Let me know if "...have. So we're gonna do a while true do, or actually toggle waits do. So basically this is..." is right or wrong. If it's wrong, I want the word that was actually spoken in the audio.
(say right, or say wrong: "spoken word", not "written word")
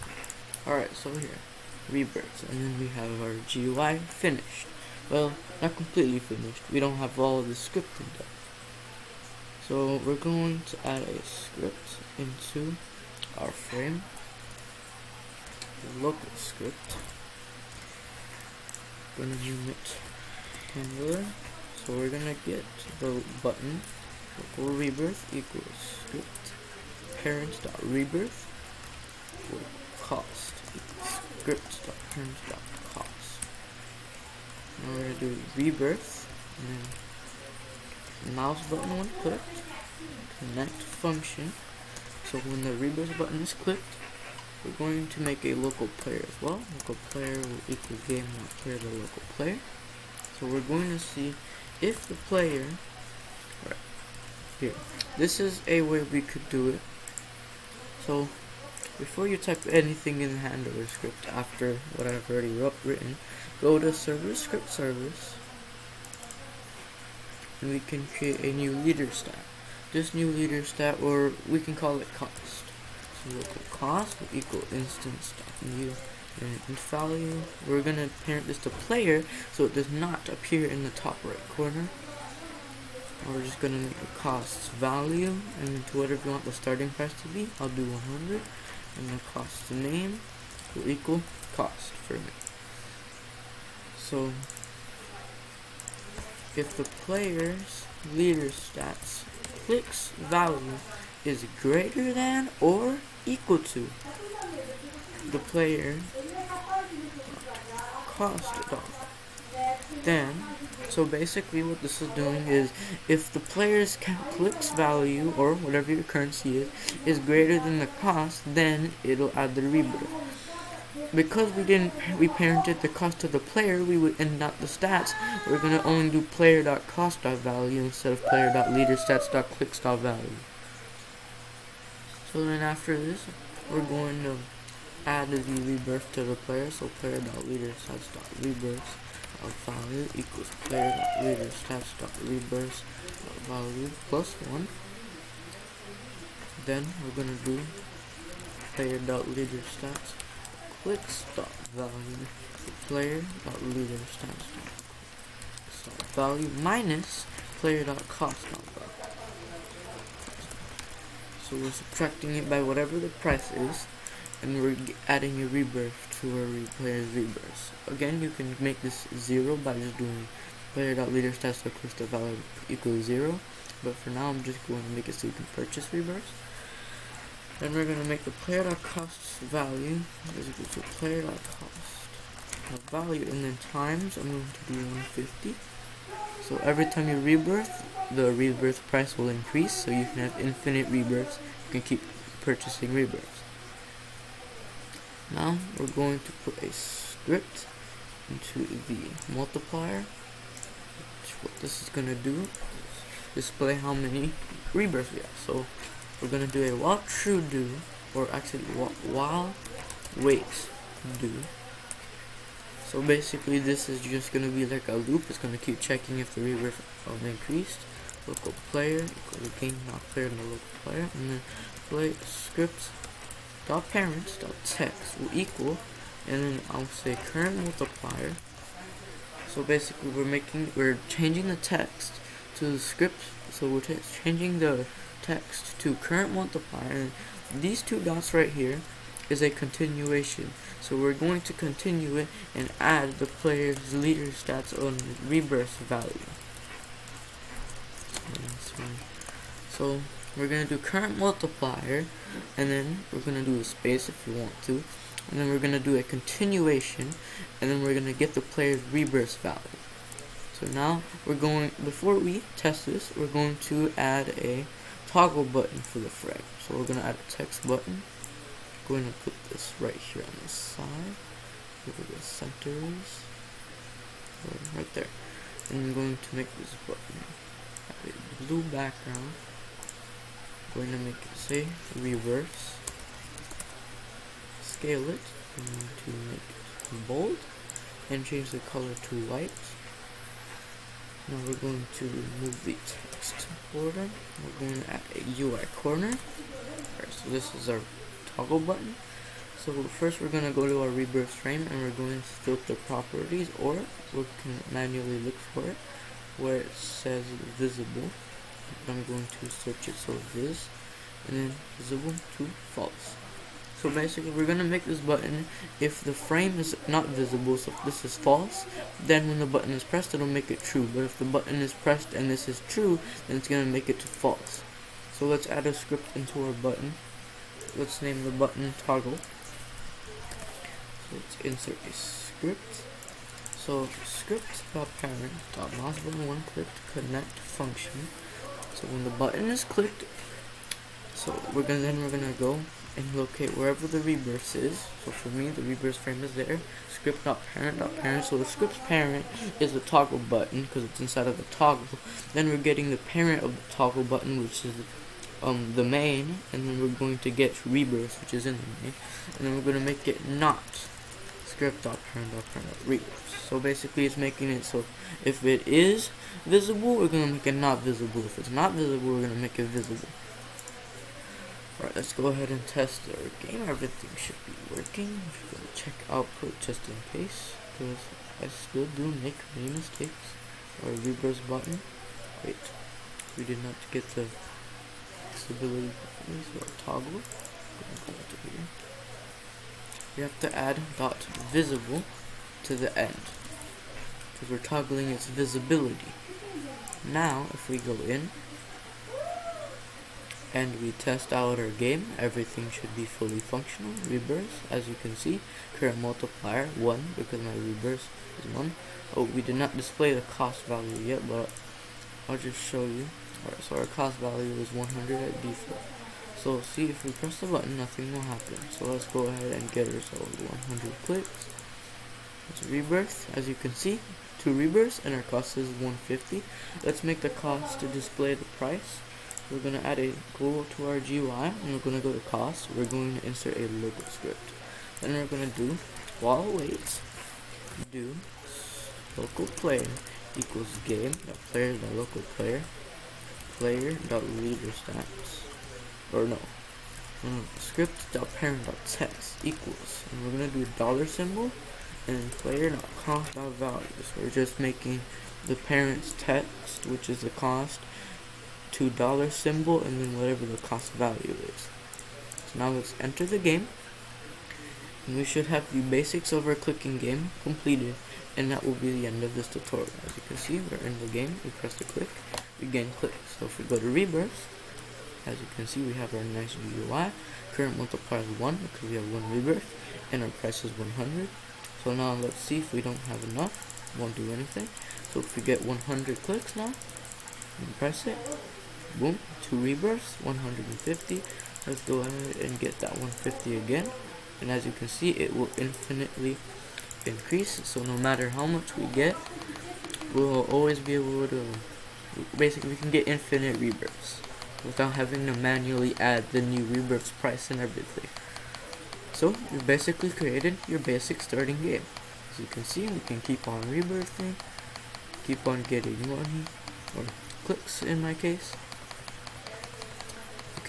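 wrong: "while", not "toggle".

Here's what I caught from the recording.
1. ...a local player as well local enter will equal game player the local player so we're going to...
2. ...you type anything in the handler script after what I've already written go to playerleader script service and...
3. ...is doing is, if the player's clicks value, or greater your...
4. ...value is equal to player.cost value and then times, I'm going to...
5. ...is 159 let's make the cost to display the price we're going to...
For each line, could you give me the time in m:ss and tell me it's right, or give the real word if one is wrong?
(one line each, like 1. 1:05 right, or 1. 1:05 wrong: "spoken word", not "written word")
1. 0:45 wrong: "player", not "enter"
2. 0:59 wrong: "server", not "playerleader"
3. 1:52 wrong: "whatever", not "greater"
4. 2:59 right
5. 7:05 wrong: "150", not "159".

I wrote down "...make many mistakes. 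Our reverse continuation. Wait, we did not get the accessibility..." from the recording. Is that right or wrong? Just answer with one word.
wrong.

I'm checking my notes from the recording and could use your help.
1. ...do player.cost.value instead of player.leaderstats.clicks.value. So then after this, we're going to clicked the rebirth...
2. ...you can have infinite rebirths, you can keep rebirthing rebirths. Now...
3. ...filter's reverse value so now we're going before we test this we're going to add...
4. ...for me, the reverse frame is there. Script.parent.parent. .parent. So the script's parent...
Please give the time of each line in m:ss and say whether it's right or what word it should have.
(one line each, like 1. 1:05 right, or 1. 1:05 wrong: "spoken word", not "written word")
1. 2:06 wrong: "added", not "clicked"
2. 3:09 wrong: "purchasing", not "rebirthing"
3. 4:18 wrong: "player", not "filter"
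4. 5:45 right.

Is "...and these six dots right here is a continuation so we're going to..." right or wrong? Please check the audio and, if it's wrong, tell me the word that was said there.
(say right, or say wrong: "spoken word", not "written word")
wrong: "two", not "six".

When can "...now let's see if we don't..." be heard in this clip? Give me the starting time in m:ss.
8:01.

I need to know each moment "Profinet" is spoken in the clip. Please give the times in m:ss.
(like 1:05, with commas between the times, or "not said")
not said.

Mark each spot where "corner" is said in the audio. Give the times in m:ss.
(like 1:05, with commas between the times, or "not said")
1:21, 4:55.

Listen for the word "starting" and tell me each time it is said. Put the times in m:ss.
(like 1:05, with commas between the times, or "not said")
1:26, 8:31.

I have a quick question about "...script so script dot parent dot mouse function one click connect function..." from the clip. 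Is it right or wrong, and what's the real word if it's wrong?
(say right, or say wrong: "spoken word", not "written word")
wrong: "button", not "function".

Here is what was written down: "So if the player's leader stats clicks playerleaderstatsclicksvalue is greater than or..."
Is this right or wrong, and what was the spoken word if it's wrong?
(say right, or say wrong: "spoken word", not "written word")
wrong: "value", not "playerleaderstatsclicksvalue".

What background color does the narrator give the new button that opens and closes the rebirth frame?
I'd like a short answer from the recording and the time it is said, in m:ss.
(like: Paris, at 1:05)
blue, at 4:38.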